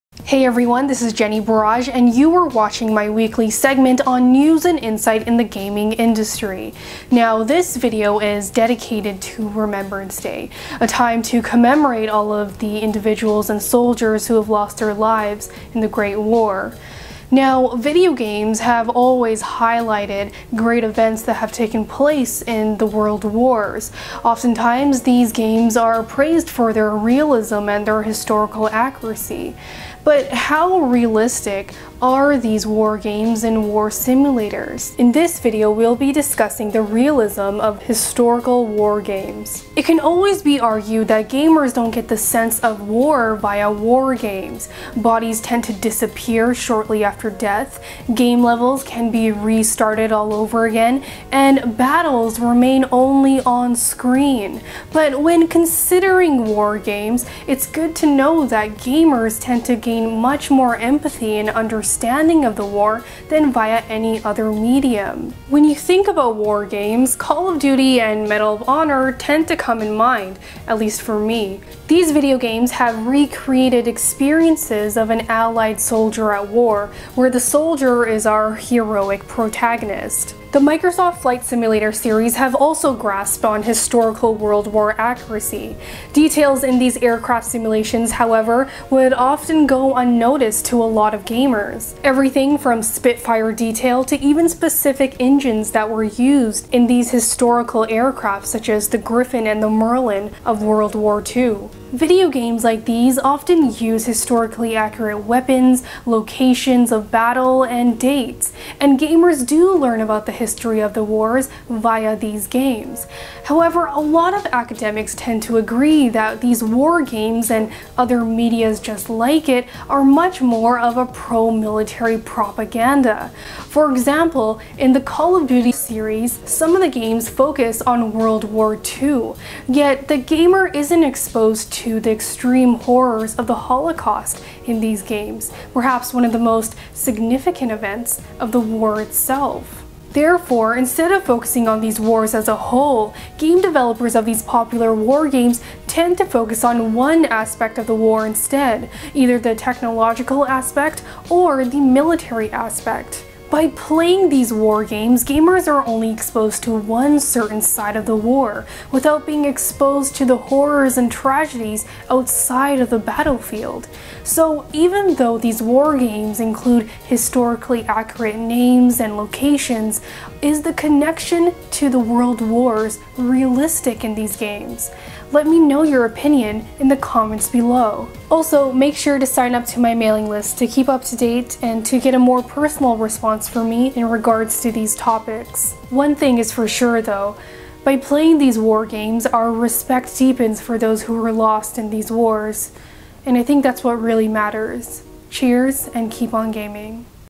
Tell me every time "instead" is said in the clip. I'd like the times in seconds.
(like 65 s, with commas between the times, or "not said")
140 s, 148 s.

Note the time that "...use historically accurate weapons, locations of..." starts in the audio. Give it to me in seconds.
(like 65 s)
103 s.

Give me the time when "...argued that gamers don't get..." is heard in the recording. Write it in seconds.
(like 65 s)
40 s.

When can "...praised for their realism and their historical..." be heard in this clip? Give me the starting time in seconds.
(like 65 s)
26 s.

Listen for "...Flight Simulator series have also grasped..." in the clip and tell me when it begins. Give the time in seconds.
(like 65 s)
81 s.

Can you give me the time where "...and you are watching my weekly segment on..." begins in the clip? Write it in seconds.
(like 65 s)
1 s.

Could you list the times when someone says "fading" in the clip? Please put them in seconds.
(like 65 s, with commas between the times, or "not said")
not said.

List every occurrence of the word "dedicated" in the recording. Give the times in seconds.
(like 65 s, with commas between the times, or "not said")
8 s.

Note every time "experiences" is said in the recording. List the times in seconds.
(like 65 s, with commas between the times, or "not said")
73 s.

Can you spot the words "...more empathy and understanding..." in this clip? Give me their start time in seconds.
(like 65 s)
60 s.